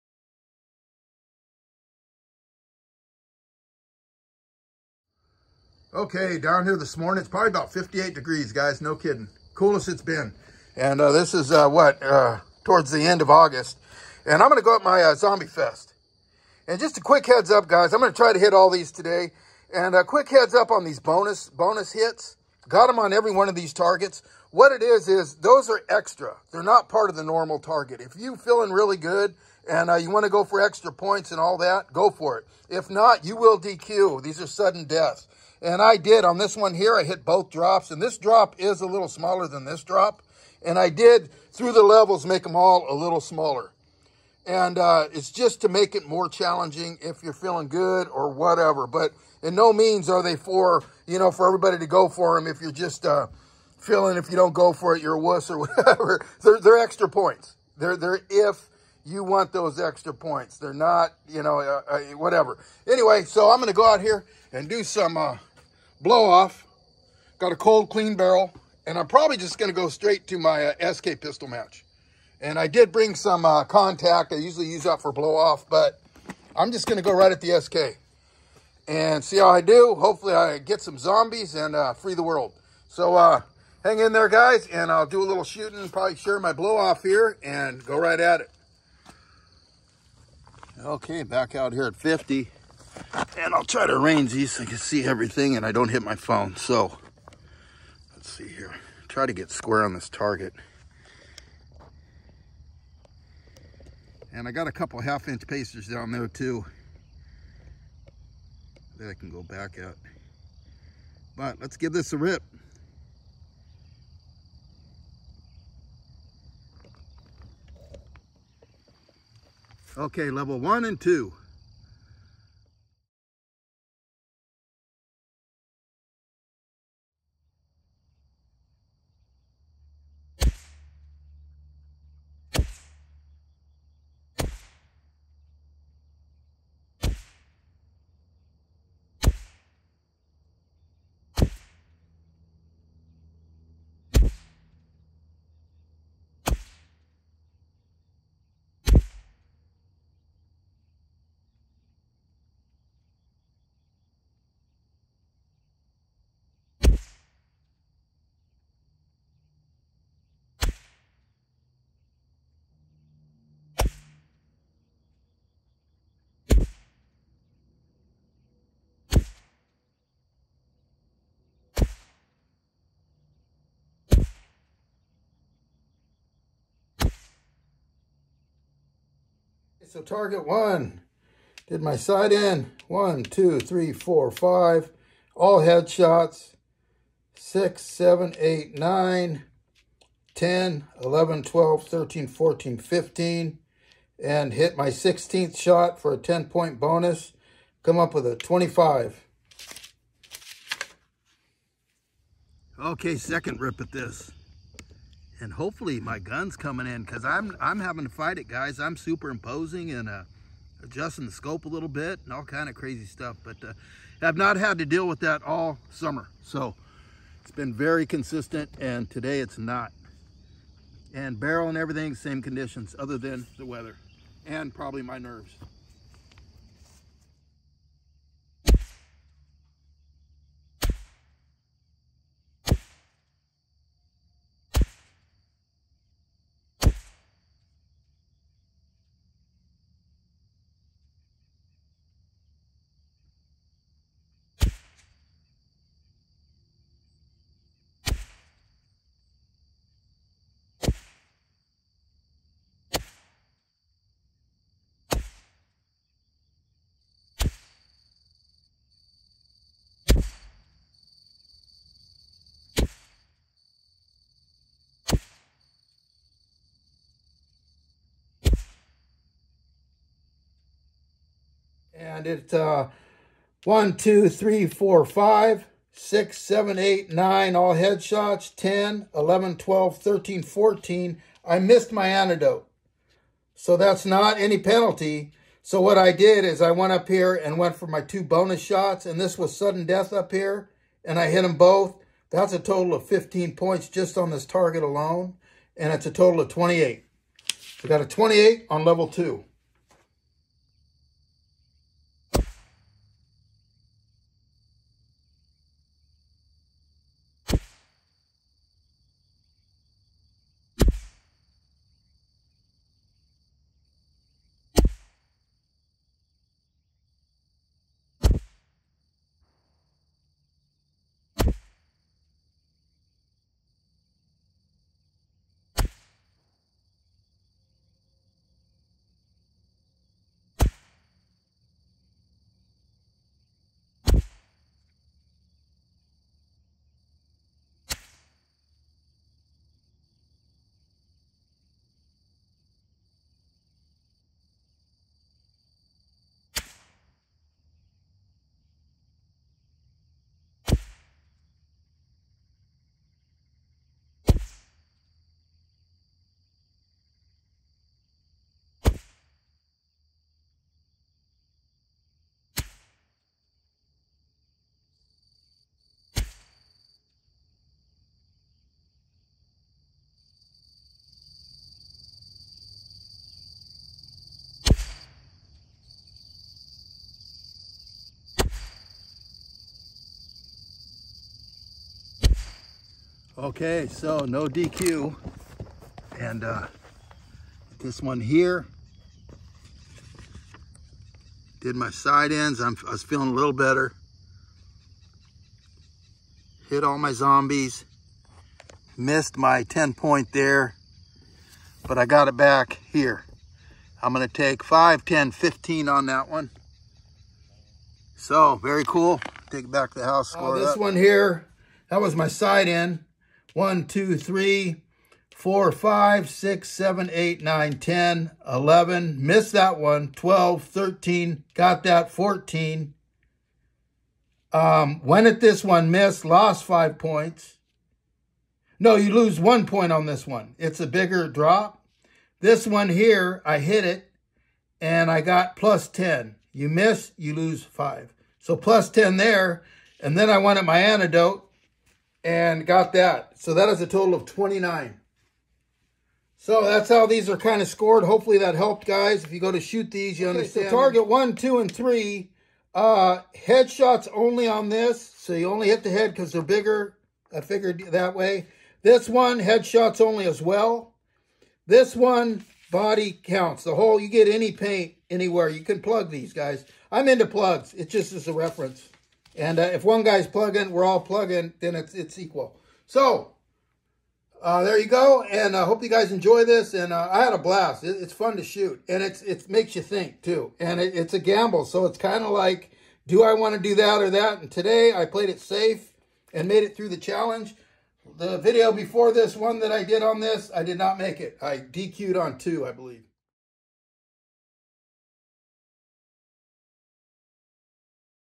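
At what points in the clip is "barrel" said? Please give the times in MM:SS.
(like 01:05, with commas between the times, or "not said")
01:08, 03:41.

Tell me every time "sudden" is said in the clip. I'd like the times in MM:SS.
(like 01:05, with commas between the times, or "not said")
00:34, 04:49.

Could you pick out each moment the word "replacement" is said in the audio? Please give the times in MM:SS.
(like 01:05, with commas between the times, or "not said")
not said.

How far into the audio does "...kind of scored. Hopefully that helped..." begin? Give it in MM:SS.
07:27.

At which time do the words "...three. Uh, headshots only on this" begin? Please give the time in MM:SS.
07:31.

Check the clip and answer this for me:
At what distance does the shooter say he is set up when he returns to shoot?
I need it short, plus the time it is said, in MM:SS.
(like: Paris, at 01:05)
50, at 01:31.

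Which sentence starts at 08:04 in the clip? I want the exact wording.
And today I played it safe and made it through the challenge.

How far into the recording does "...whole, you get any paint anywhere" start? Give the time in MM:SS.
07:43.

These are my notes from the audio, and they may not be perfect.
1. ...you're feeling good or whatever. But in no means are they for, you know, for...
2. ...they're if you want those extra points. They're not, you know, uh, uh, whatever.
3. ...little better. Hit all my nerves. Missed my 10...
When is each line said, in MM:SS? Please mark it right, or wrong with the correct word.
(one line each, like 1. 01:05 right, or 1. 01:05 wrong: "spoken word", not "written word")
1. 00:47 right
2. 00:57 right
3. 06:33 wrong: "zombies", not "nerves".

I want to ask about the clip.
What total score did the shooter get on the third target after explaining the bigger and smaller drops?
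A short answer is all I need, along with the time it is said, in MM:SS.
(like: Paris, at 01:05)
29, at 07:24.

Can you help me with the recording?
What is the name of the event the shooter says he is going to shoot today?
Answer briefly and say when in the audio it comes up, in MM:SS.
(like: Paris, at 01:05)
Zombie Fest, at 00:15.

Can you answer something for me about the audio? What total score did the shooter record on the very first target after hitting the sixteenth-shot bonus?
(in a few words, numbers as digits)
25.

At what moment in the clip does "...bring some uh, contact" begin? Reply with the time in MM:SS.
01:12.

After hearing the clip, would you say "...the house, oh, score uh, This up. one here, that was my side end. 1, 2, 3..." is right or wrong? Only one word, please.
right.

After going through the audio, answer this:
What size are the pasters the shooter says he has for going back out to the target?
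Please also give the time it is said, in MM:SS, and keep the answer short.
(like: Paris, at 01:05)
half-inch, at 01:45.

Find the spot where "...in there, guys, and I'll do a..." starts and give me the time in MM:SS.
01:23.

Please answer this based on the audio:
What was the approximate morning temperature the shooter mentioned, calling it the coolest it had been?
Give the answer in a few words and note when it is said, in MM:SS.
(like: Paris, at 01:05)
58 degrees, at 00:07.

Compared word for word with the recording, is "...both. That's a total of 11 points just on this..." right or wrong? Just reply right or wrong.
wrong.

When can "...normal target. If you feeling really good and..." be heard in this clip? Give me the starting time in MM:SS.
00:27.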